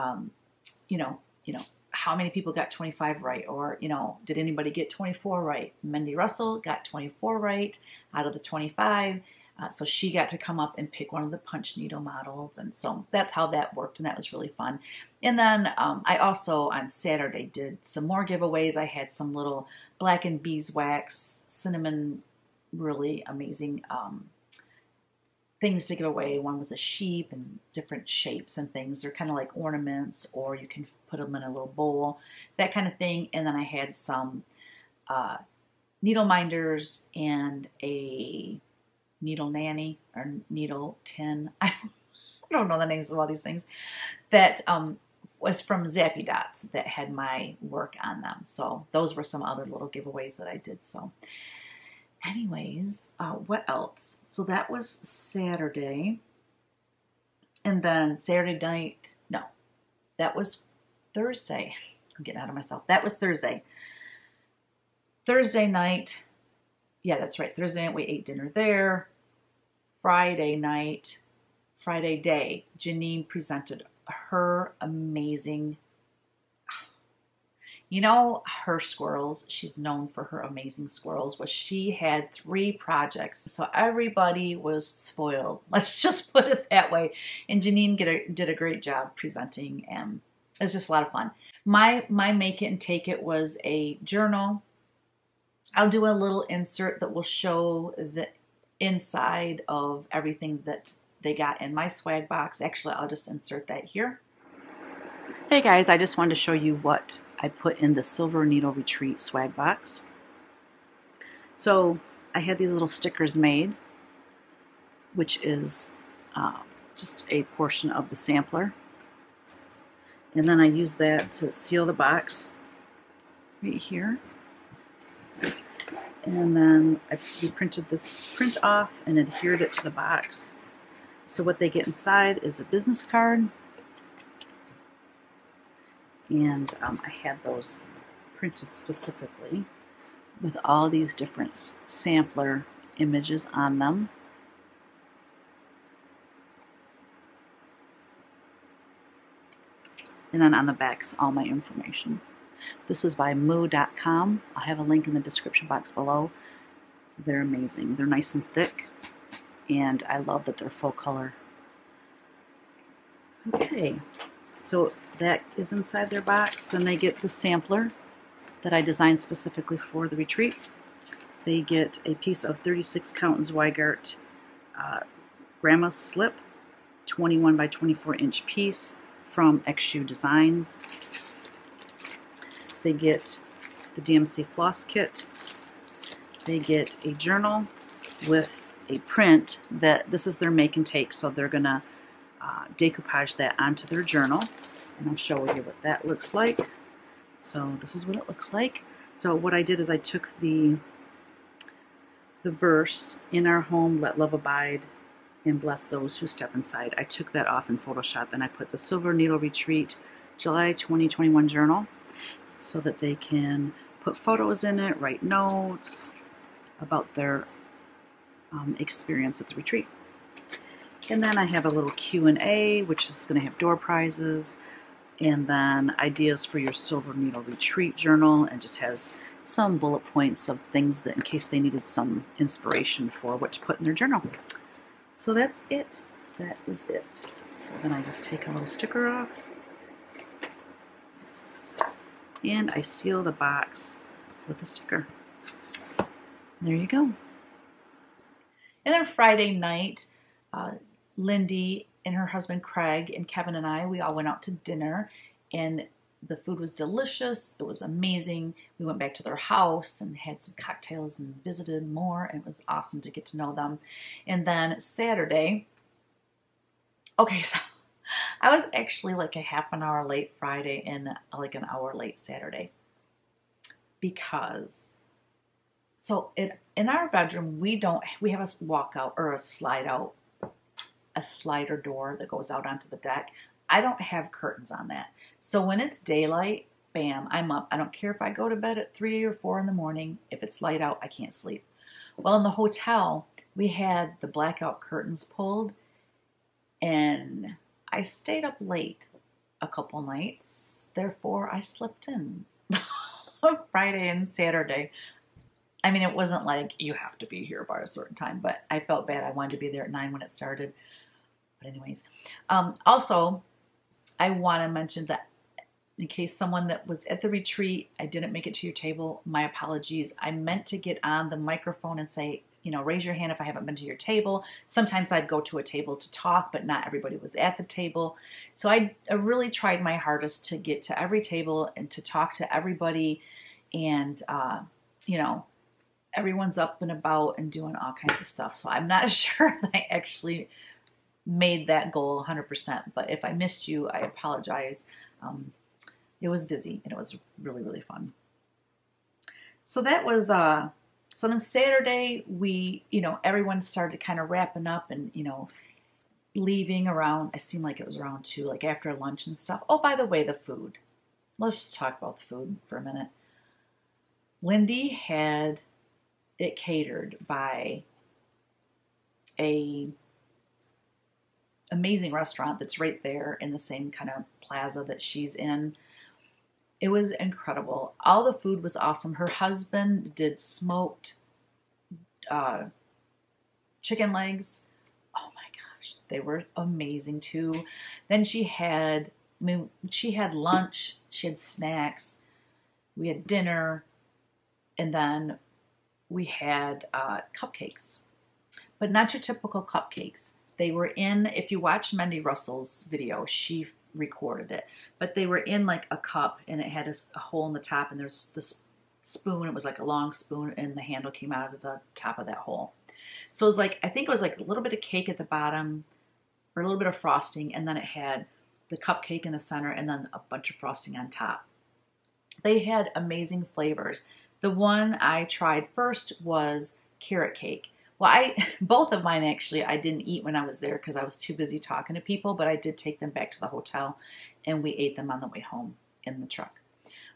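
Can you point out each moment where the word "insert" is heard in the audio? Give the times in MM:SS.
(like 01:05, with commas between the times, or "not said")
01:36, 01:43.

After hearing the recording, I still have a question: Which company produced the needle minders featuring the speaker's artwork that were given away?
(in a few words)
Zappy Dots.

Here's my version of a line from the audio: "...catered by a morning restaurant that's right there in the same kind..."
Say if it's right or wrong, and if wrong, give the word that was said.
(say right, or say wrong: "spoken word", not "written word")
wrong: "amazing", not "morning".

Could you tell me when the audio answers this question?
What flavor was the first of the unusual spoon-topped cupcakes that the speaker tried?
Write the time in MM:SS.
07:06.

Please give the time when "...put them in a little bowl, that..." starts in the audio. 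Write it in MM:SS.
00:31.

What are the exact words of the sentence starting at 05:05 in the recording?
I mean, it wasn't like you have to be here by a certain time, but I felt bad.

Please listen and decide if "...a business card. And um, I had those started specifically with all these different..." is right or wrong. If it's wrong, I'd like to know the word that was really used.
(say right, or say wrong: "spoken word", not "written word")
wrong: "printed", not "started".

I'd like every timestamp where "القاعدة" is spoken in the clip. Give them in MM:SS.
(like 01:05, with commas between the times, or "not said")
not said.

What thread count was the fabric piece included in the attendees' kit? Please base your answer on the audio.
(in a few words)
36 count.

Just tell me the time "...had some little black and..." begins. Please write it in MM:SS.
00:18.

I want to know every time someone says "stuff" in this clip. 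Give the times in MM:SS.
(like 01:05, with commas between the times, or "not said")
05:38, 05:59.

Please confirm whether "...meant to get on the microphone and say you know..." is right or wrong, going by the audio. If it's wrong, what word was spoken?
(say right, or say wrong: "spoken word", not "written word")
right.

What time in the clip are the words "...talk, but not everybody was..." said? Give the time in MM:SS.
05:26.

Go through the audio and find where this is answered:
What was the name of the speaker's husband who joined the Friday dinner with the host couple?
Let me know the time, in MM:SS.
04:13.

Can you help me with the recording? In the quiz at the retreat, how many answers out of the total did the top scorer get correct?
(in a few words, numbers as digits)
24.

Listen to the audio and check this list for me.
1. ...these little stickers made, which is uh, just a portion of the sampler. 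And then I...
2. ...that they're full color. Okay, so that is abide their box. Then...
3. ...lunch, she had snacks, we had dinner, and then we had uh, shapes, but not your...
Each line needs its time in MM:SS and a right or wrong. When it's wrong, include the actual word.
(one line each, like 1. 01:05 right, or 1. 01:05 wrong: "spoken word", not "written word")
1. 01:52 right
2. 02:40 wrong: "inside", not "abide"
3. 06:30 wrong: "cupcakes", not "shapes".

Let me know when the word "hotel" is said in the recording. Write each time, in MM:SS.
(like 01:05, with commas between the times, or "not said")
04:52, 07:13.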